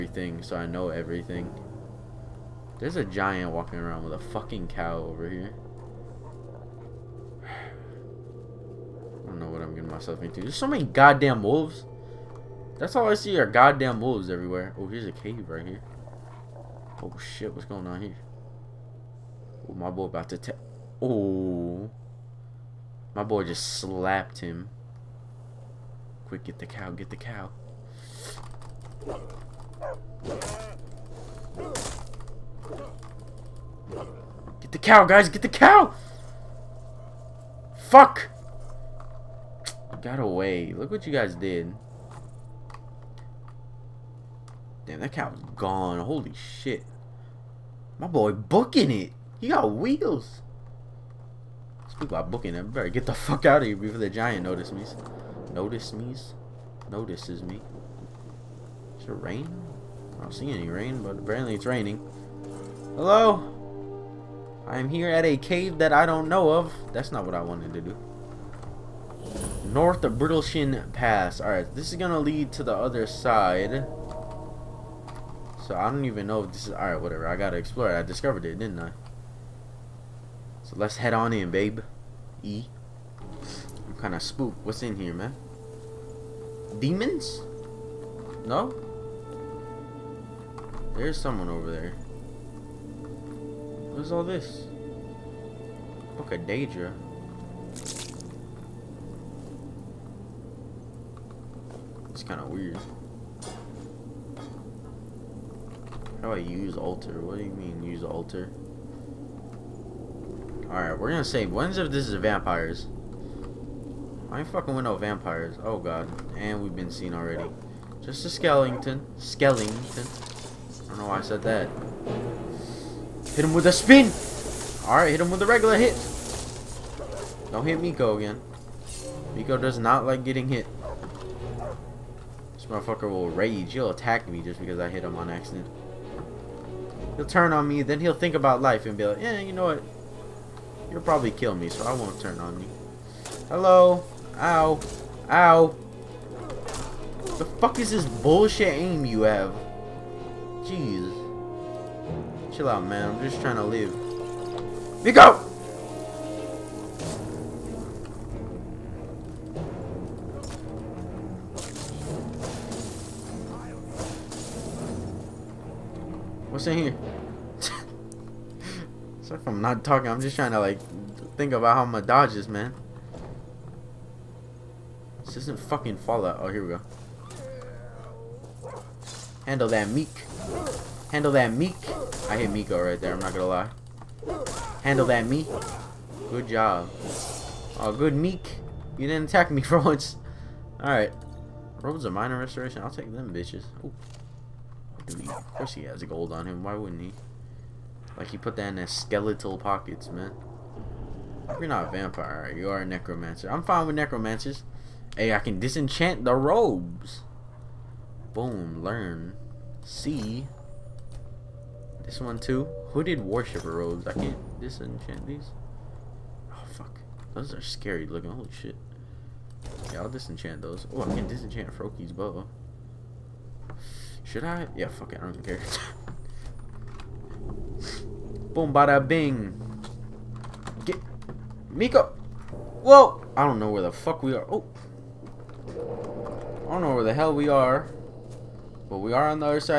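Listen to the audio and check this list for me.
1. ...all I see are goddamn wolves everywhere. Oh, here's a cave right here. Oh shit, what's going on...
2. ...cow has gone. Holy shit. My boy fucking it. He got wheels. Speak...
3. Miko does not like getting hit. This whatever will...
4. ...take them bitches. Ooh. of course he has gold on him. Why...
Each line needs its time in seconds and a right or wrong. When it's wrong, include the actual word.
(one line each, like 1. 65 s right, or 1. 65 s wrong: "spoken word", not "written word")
1. 12 s right
2. 45 s wrong: "booking", not "fucking"
3. 129 s wrong: "motherfucker", not "whatever"
4. 192 s right.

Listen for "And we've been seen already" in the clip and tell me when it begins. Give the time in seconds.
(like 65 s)
116 s.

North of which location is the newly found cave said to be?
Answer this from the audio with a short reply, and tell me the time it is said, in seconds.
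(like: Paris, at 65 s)
Brittleshin Pass, at 70 s.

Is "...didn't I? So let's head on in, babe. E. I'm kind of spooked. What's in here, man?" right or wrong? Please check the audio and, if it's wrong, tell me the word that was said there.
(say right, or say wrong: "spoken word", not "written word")
right.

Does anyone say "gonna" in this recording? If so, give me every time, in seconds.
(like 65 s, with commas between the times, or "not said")
71 s, 111 s, 183 s.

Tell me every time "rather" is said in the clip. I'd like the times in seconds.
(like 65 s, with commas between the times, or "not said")
not said.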